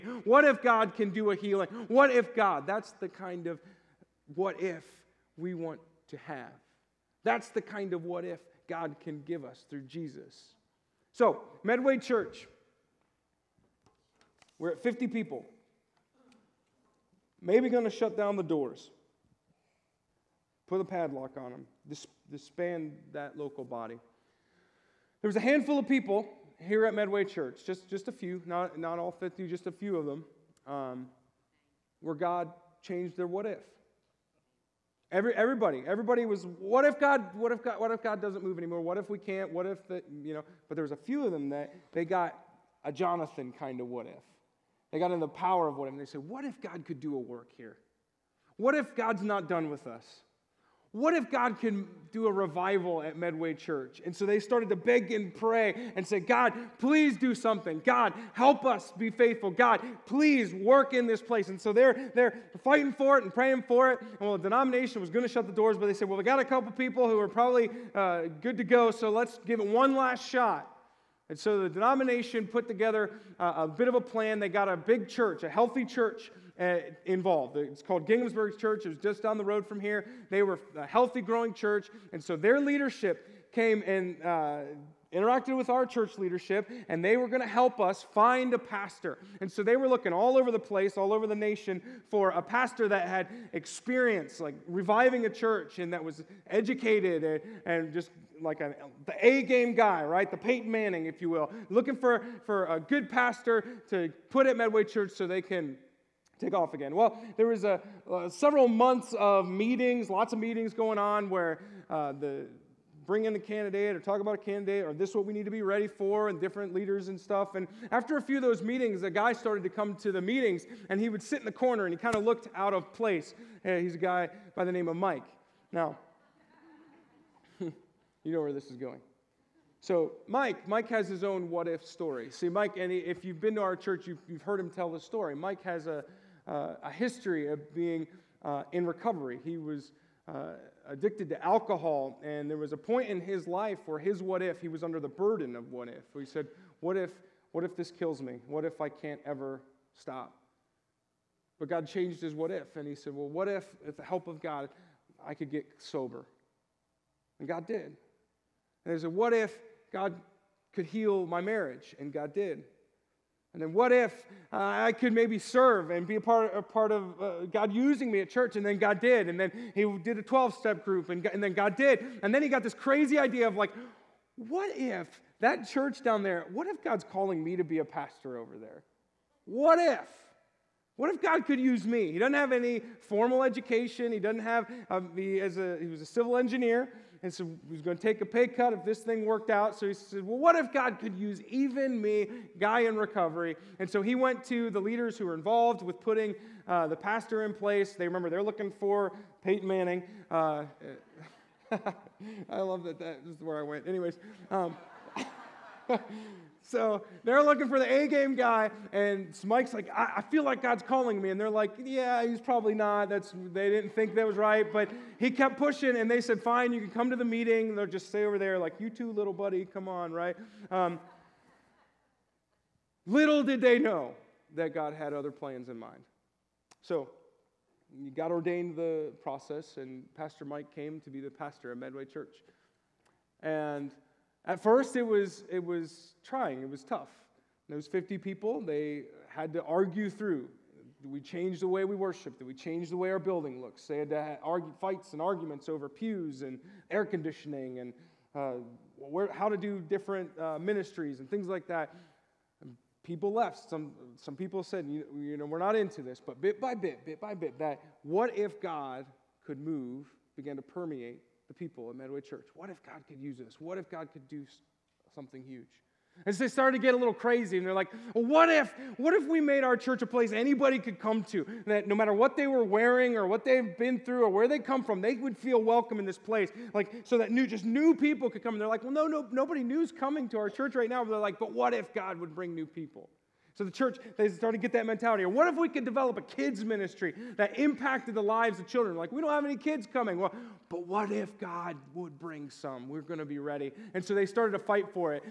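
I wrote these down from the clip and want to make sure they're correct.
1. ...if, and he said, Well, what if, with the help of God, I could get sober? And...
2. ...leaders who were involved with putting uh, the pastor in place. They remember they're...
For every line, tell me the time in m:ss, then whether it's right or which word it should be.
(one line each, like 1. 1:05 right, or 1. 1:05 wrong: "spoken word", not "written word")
1. 2:32 right
2. 3:14 right.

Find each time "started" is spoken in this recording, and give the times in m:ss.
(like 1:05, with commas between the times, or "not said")
0:54, 1:59, 4:26, 4:44, 4:54.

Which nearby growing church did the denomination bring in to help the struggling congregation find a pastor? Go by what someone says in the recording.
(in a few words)
Ginghamsburg Church.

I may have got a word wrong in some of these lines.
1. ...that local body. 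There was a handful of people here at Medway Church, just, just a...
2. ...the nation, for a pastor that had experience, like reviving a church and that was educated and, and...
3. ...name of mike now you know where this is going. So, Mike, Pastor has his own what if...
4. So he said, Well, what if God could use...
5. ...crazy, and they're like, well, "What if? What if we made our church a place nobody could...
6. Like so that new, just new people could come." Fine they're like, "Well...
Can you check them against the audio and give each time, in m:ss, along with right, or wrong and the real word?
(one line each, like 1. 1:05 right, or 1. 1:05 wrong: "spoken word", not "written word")
1. 0:23 right
2. 1:31 right
3. 2:04 wrong: "Mike", not "Pastor"
4. 3:09 right
5. 4:27 wrong: "anybody", not "nobody"
6. 4:36 wrong: "And", not "Fine".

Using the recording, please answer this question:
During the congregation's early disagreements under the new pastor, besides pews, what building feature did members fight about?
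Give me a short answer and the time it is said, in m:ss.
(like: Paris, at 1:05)
air conditioning, at 4:06.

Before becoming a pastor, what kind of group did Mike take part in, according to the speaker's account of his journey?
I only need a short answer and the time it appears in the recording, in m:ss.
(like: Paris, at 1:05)
12 step group, at 2:50.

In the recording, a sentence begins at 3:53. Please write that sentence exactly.
And at first, it was, it was trying, it was tough.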